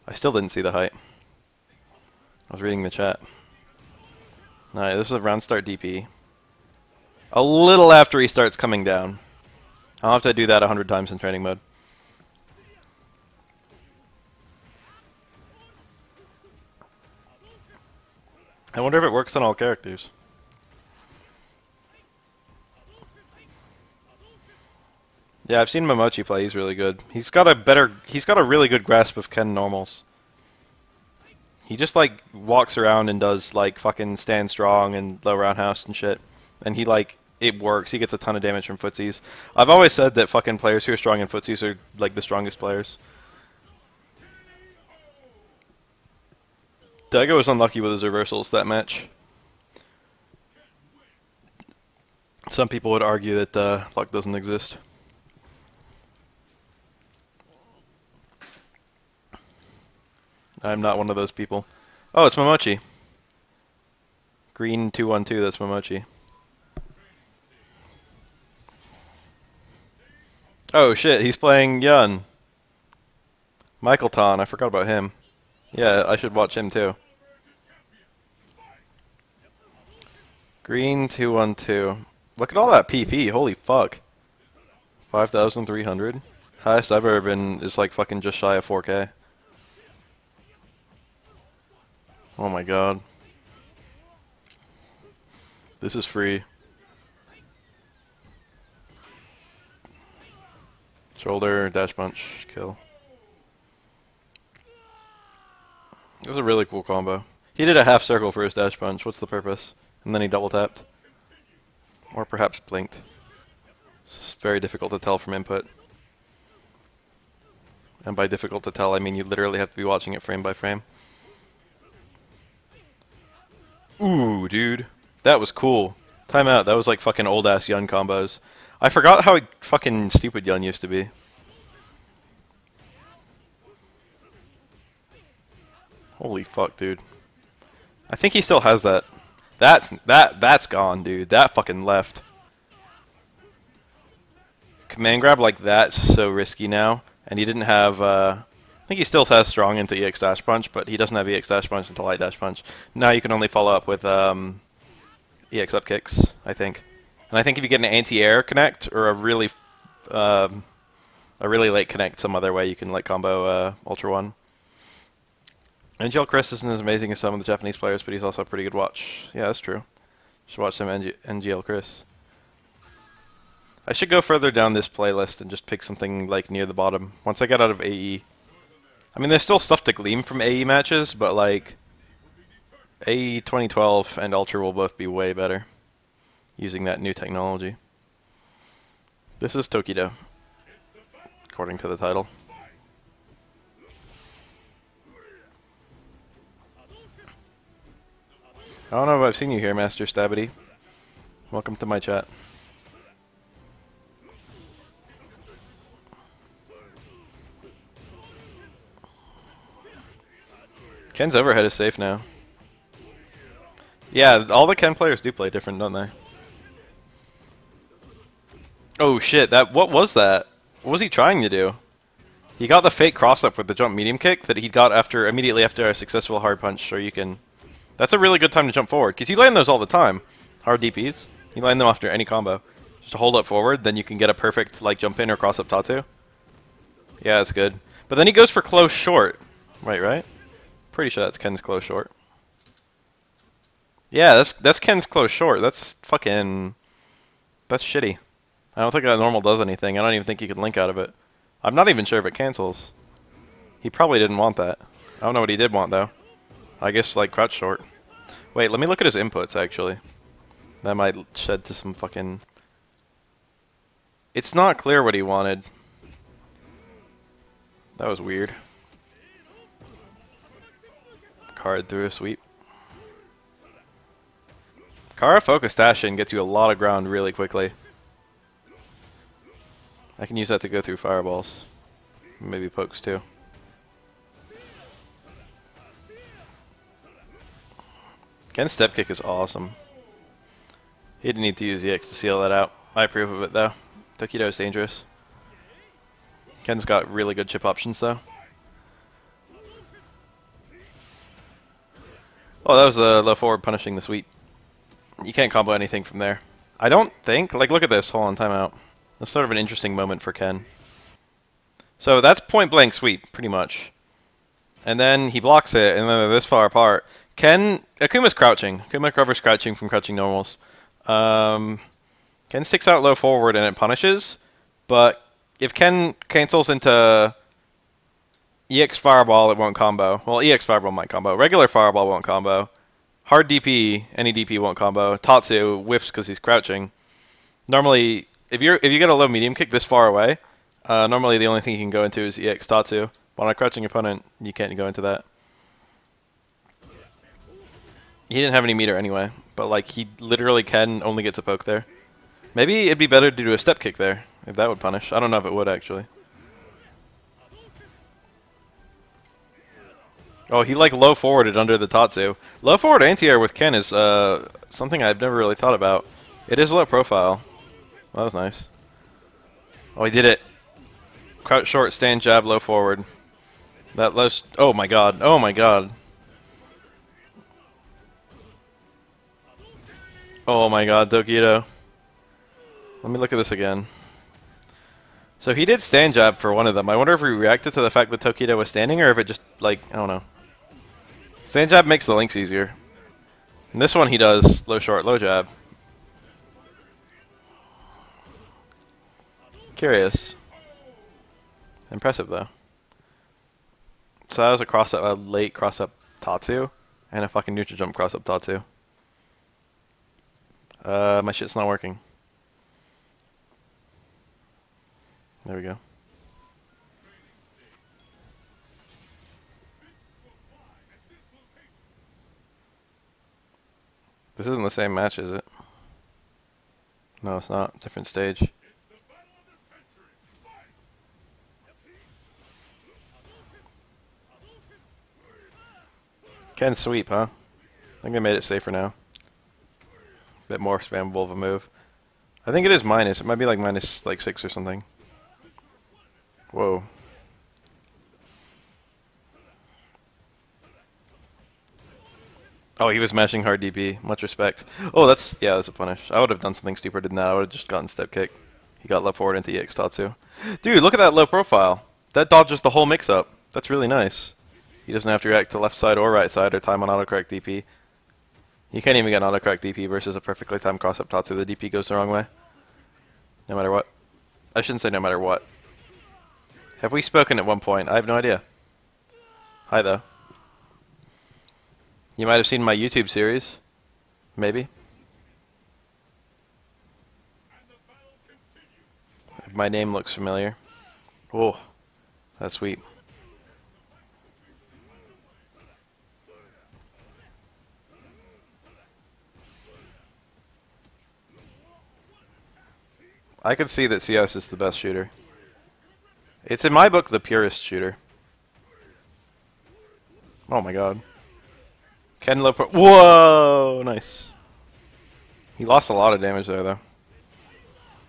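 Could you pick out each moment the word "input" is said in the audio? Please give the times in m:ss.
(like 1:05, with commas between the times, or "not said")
1:55, 4:19.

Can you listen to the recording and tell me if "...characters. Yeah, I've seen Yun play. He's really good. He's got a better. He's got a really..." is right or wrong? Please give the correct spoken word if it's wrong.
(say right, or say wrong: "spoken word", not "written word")
wrong: "Momochi", not "Yun".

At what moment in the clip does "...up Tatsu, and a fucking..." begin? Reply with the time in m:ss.
6:45.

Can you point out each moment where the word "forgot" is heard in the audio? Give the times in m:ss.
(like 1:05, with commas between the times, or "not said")
1:14, 2:08.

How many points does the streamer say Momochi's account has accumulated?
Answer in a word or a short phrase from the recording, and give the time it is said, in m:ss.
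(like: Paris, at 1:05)
5,300, at 1:25.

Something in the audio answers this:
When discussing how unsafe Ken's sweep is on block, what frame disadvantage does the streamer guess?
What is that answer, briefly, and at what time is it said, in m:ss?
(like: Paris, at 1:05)
minus 6, at 7:23.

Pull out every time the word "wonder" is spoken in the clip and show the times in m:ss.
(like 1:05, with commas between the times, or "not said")
0:18, 6:26.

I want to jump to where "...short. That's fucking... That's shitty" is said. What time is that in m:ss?
4:05.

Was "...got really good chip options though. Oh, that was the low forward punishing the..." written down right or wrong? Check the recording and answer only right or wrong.
right.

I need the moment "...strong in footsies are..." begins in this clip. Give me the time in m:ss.
0:40.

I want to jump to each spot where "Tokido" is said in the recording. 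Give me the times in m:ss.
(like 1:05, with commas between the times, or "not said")
3:09, 4:54, 6:21, 6:28.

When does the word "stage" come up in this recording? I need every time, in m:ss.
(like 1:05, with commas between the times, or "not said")
7:08.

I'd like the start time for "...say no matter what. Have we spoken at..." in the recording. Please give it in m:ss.
7:54.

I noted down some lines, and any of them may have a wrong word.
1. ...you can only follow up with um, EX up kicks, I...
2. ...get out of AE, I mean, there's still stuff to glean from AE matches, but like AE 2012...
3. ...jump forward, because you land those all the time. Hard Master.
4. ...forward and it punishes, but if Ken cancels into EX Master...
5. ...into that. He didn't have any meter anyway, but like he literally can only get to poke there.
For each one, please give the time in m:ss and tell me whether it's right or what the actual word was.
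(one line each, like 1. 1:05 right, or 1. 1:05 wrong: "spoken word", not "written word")
1. 2:33 right
2. 2:57 right
3. 3:48 wrong: "DPs", not "Master"
4. 5:23 wrong: "Fireball", not "Master"
5. 5:44 right.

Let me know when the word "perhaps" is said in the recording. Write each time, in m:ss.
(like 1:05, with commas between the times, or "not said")
1:52.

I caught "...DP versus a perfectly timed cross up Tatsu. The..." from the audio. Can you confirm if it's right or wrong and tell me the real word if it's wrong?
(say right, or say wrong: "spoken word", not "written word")
right.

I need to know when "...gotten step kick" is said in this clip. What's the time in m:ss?
7:37.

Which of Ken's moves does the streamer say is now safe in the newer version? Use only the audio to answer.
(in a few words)
Ken's overhead.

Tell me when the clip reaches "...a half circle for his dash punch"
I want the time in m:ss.
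1:47.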